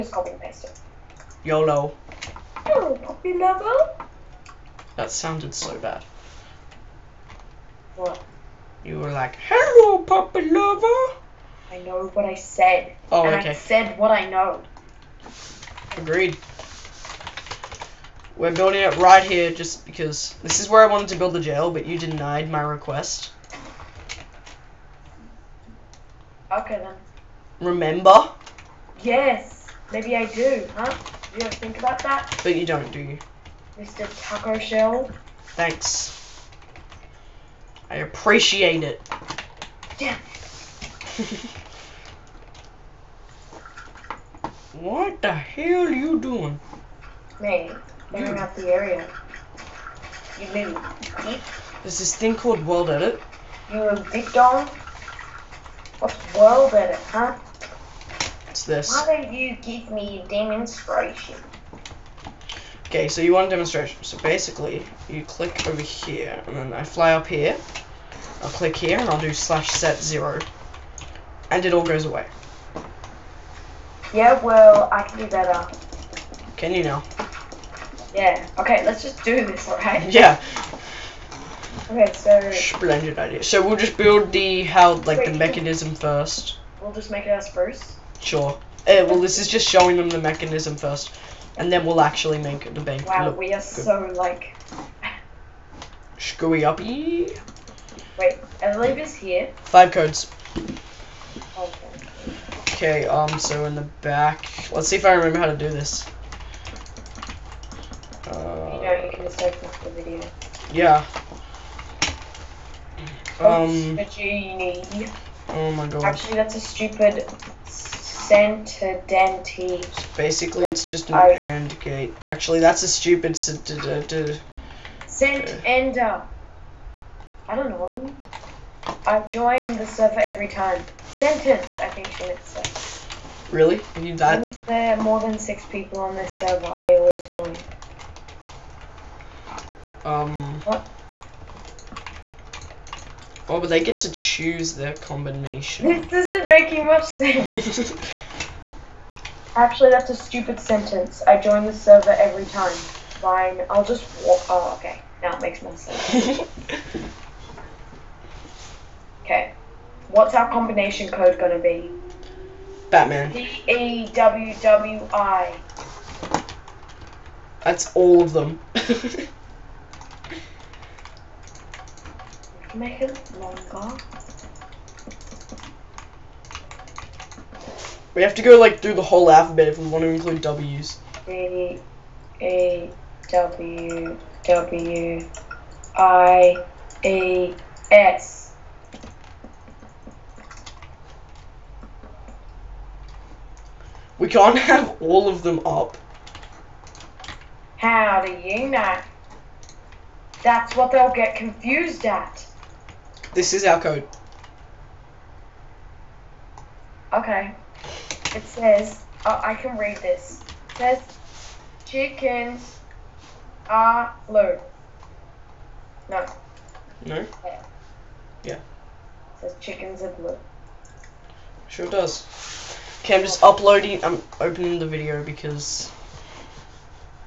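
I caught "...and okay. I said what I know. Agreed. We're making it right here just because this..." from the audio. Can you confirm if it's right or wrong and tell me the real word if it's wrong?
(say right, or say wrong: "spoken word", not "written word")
wrong: "building", not "making".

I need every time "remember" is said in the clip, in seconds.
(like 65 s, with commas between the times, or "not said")
27 s, 105 s.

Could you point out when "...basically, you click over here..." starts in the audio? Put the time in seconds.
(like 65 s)
64 s.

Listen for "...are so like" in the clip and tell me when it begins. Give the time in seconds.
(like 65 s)
93 s.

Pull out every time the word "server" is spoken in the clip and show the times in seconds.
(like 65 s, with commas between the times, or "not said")
129 s, 136 s, 151 s.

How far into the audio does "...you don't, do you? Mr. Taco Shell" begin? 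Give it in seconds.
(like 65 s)
32 s.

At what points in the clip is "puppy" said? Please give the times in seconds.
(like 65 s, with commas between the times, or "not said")
3 s, 9 s.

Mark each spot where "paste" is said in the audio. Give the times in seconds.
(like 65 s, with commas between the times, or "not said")
0 s.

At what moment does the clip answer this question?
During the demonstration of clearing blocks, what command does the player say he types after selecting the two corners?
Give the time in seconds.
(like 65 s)
69 s.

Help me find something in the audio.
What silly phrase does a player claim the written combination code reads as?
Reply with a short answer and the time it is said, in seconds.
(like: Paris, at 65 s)
Chickens are blue, at 219 s.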